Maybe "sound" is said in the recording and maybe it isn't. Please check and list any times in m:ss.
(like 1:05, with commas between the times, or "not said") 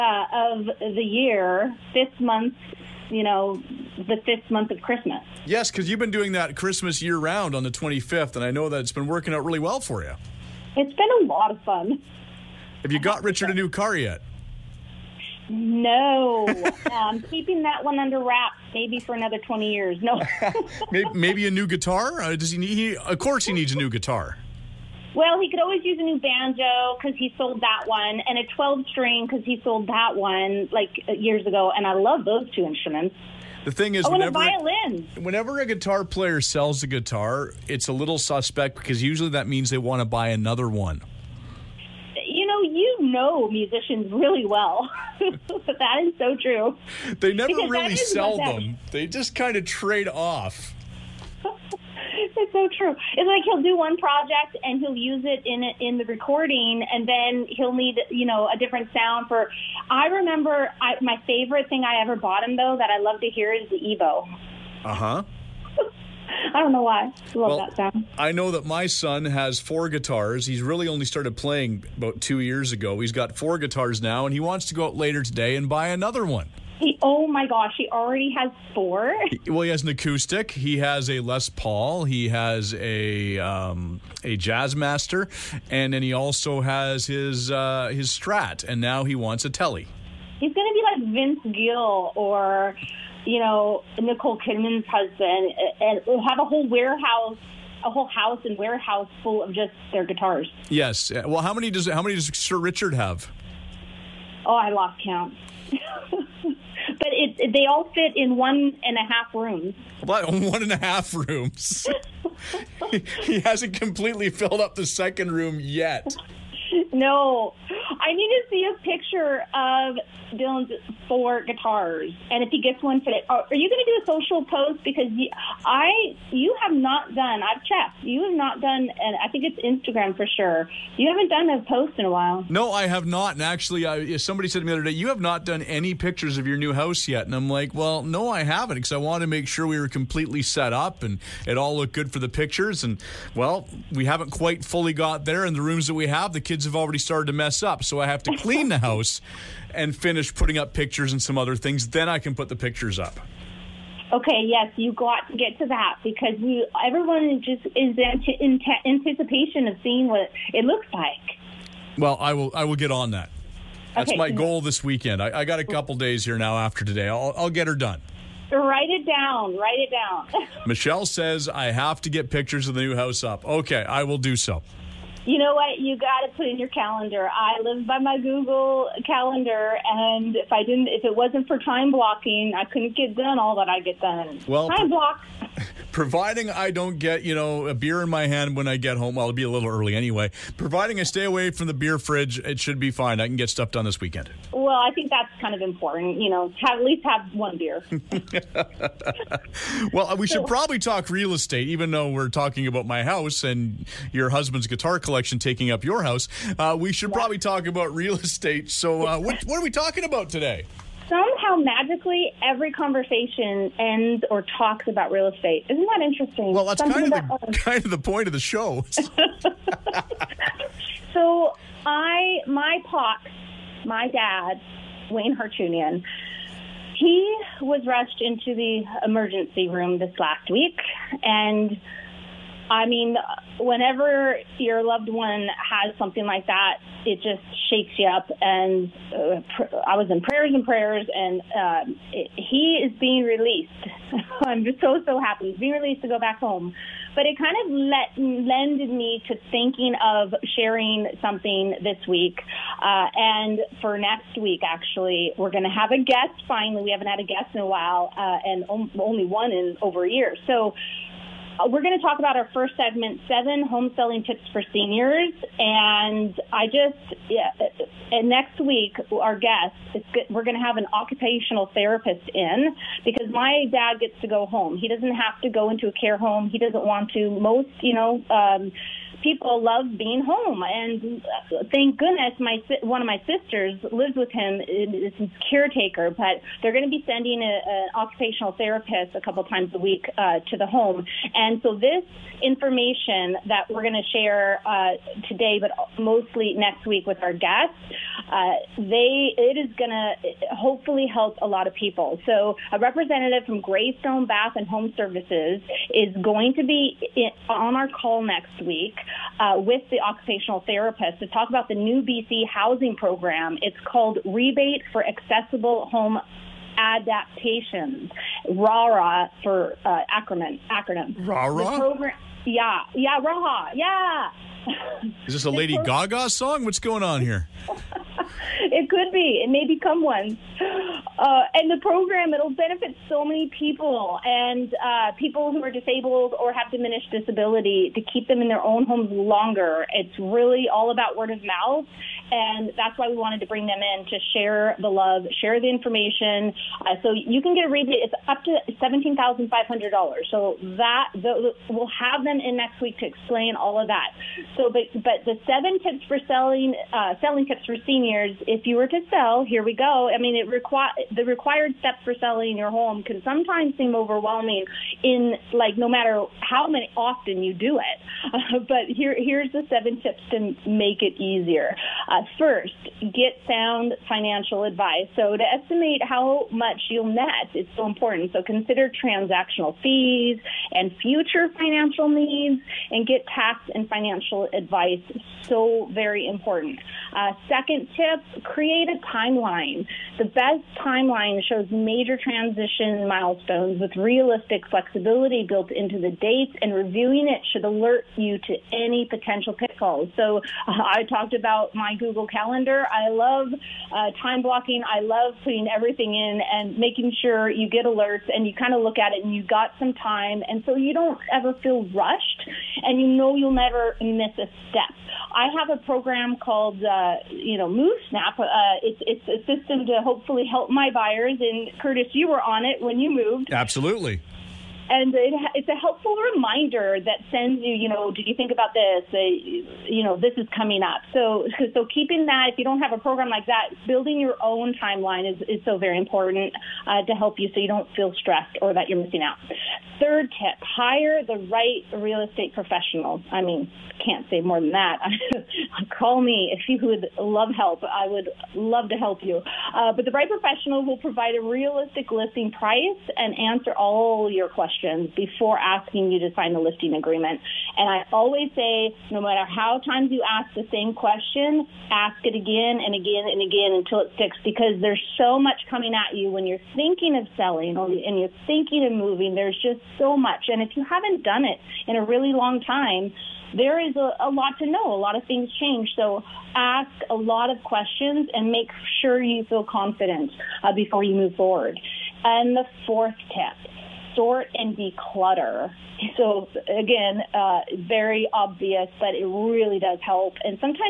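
0:58, 1:07, 6:13.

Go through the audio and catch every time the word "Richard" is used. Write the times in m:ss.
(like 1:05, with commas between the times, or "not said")
0:13, 1:42.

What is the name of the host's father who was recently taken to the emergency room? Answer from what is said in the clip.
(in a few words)
Wayne Hartunian.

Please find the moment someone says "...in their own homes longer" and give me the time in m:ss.
5:38.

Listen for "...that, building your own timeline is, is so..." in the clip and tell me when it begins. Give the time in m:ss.
7:13.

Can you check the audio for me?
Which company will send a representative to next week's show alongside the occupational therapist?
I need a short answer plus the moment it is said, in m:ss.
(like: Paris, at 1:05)
Greystone Bath and Home Services, at 5:03.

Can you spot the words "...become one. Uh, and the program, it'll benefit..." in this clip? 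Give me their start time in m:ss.
5:29.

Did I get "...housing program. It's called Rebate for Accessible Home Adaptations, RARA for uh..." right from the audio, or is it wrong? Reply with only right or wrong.
right.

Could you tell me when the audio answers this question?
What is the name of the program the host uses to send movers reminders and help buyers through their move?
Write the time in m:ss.
6:57.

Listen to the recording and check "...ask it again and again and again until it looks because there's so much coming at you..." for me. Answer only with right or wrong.
wrong.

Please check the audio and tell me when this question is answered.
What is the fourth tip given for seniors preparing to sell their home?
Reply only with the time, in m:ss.
8:04.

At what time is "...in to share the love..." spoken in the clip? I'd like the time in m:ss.
5:43.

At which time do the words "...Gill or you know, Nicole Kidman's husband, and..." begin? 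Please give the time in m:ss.
1:31.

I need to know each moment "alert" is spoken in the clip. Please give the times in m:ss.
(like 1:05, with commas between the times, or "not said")
6:37, 6:47.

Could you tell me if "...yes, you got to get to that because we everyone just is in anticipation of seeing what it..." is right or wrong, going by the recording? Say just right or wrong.
right.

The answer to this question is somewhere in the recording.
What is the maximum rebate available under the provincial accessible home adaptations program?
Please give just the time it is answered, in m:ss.
5:48.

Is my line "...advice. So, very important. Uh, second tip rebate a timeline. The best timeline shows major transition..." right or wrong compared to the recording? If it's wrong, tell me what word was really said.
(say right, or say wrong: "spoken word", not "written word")
wrong: "create", not "rebate".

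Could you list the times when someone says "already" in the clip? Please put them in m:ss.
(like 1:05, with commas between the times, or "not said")
1:17, 2:26.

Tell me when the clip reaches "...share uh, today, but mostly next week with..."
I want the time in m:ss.
4:54.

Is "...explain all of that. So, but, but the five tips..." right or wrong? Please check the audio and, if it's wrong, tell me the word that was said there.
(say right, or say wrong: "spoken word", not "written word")
wrong: "seven", not "five".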